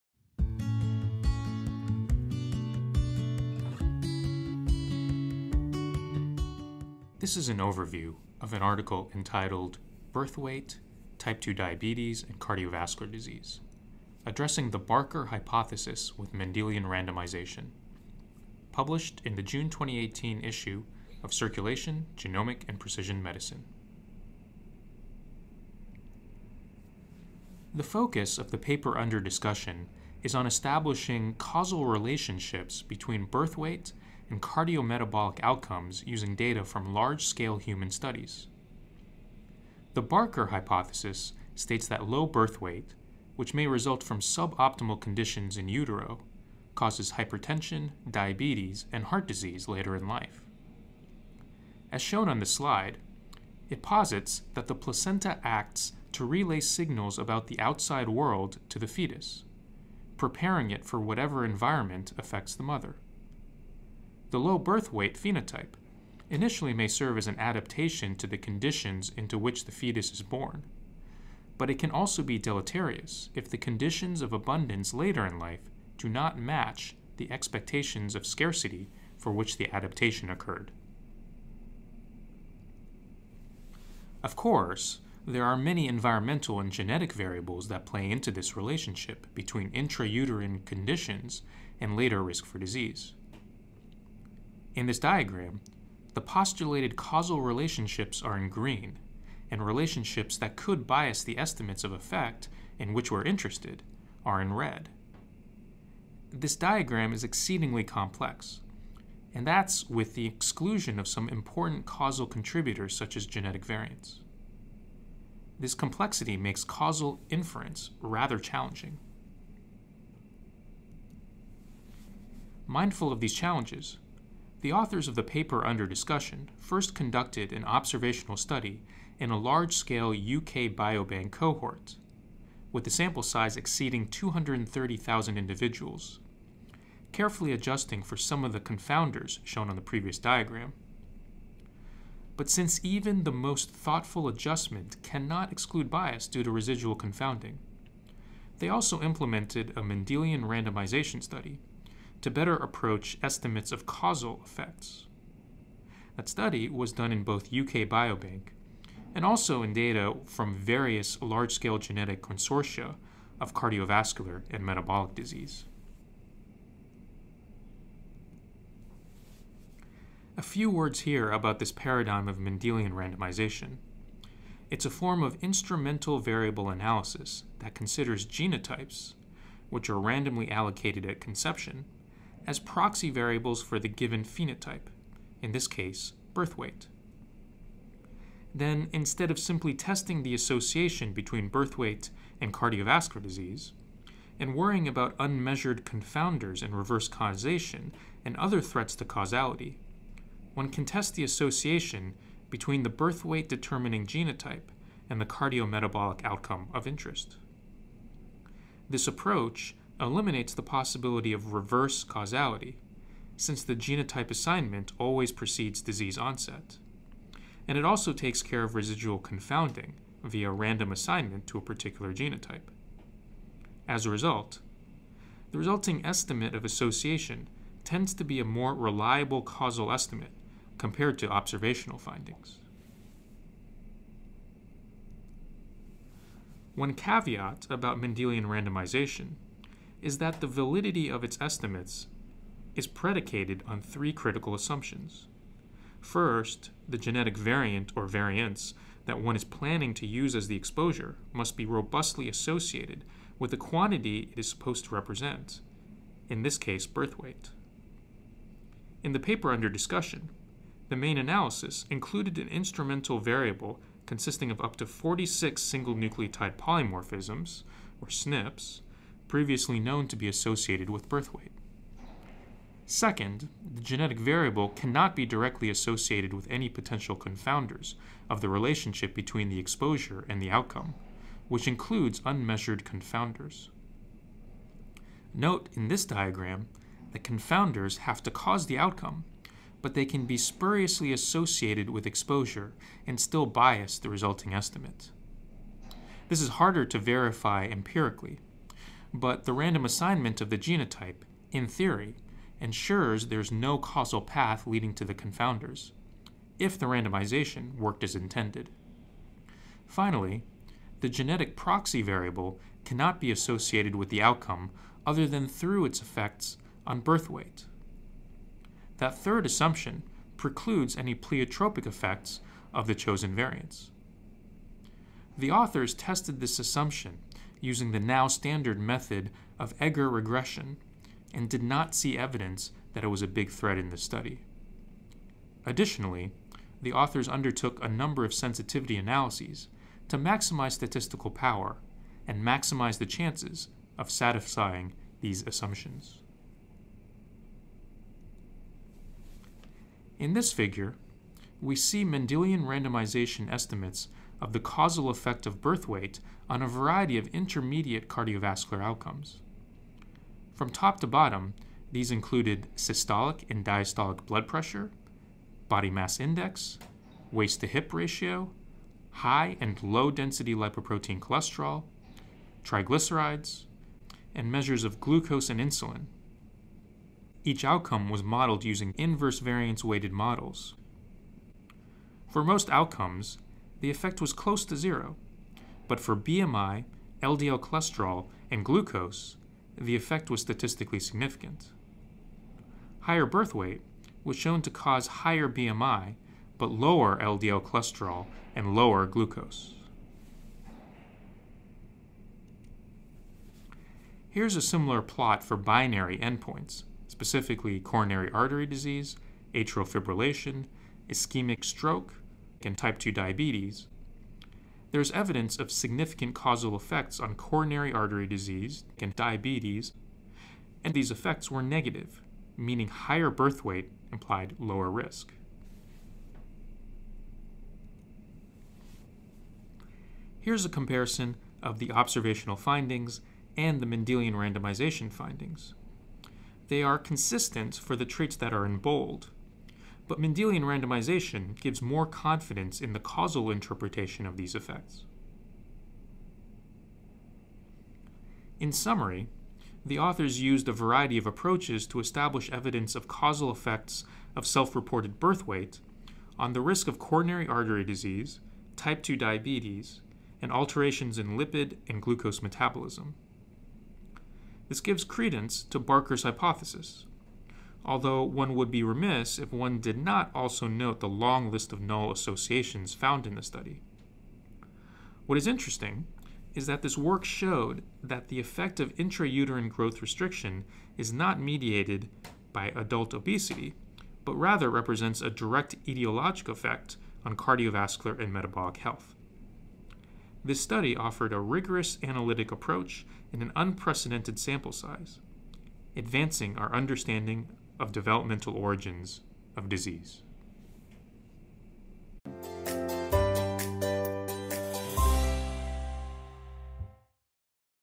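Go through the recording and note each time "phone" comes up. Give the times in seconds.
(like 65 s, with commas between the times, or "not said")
not said.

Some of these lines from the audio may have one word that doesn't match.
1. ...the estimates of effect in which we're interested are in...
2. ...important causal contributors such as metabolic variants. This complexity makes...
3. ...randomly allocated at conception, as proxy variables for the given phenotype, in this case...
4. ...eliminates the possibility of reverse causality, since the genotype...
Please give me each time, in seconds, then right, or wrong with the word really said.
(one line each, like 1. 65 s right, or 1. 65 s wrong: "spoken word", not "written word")
1. 101 s right
2. 111 s wrong: "genetic", not "metabolic"
3. 179 s right
4. 210 s right.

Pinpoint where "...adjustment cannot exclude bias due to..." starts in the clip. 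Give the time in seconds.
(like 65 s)
144 s.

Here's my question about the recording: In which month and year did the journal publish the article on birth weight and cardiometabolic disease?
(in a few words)
June 2018.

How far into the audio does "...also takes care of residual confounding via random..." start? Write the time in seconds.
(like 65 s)
217 s.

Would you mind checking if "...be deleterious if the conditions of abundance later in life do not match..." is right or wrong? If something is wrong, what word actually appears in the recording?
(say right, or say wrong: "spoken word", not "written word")
right.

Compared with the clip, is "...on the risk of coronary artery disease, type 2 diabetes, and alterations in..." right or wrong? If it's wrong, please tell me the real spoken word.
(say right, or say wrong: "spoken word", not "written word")
right.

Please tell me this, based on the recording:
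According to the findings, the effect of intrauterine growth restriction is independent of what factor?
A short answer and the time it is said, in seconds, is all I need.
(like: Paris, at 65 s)
adult obesity, at 482 s.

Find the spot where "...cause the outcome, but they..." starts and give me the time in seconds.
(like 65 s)
288 s.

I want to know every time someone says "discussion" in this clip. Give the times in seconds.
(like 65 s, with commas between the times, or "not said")
29 s, 125 s, 259 s.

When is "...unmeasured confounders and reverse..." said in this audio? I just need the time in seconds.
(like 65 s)
195 s.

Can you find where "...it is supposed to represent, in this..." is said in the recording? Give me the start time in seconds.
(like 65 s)
254 s.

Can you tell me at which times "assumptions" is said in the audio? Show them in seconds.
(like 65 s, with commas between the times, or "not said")
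244 s, 319 s, 326 s, 345 s.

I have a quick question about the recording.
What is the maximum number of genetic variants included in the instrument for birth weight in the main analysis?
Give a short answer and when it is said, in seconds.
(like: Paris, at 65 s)
46, at 264 s.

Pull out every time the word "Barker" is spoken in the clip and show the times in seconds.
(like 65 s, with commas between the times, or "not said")
14 s, 40 s, 465 s.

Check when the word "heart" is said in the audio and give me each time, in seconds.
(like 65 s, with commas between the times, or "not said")
49 s.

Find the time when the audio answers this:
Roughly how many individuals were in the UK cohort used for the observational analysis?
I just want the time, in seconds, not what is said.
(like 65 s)
134 s.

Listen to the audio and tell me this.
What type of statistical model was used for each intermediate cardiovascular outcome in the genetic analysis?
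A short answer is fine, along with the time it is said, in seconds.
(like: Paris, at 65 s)
inverse variance weighted, at 378 s.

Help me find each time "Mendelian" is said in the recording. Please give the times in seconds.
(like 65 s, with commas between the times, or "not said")
16 s, 149 s, 172 s, 237 s, 352 s, 433 s, 440 s.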